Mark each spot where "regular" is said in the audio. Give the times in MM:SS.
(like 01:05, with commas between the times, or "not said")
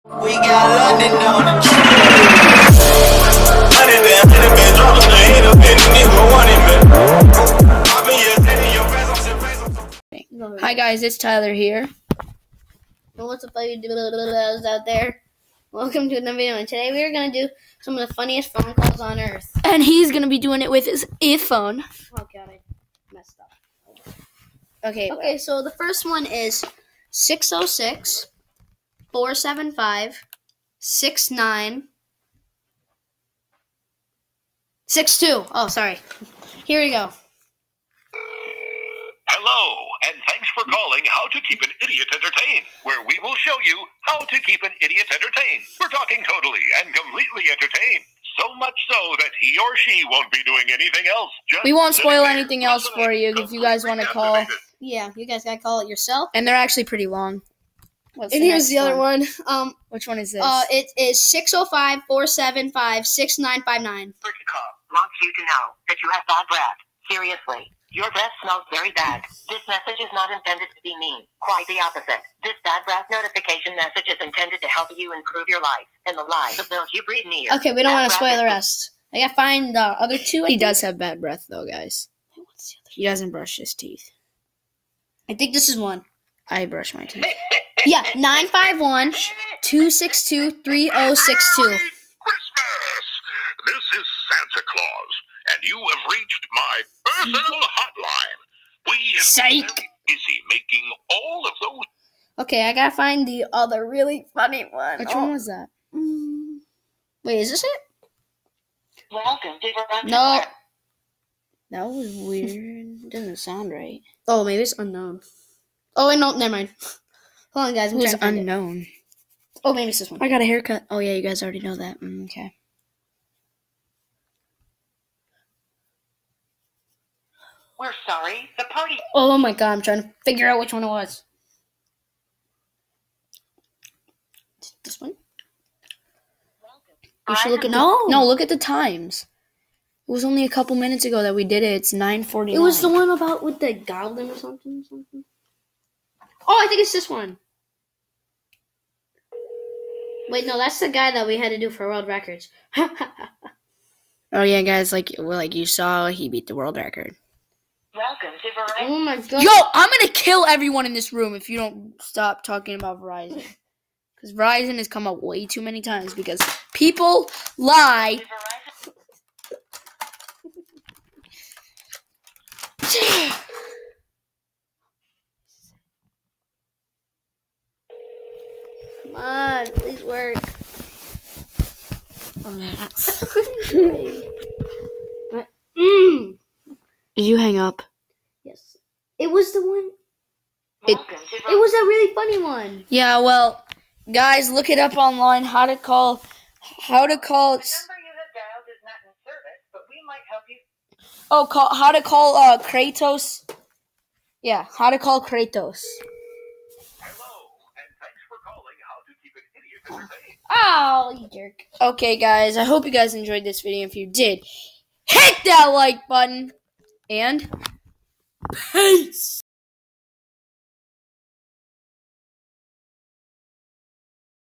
not said.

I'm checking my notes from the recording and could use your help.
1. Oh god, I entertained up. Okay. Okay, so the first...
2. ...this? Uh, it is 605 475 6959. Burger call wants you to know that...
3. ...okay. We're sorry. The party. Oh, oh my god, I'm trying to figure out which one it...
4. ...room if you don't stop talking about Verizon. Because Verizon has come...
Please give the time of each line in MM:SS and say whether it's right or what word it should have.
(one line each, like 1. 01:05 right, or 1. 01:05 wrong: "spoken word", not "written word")
1. 00:22 wrong: "messed", not "entertained"
2. 01:00 right
3. 02:02 right
4. 02:41 right.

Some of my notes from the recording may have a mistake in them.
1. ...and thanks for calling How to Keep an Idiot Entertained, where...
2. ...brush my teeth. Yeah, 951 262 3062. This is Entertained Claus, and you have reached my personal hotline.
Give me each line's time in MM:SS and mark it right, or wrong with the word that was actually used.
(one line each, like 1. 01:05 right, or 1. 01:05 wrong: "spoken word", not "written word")
1. 00:40 right
2. 01:26 wrong: "Santa", not "Entertained".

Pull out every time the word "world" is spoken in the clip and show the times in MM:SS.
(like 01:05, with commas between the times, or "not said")
02:31, 02:36.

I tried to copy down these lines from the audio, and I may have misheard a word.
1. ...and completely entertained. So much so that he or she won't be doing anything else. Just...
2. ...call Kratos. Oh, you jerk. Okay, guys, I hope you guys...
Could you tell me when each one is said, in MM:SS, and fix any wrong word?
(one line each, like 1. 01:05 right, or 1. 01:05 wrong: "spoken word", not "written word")
1. 00:46 right
2. 03:24 right.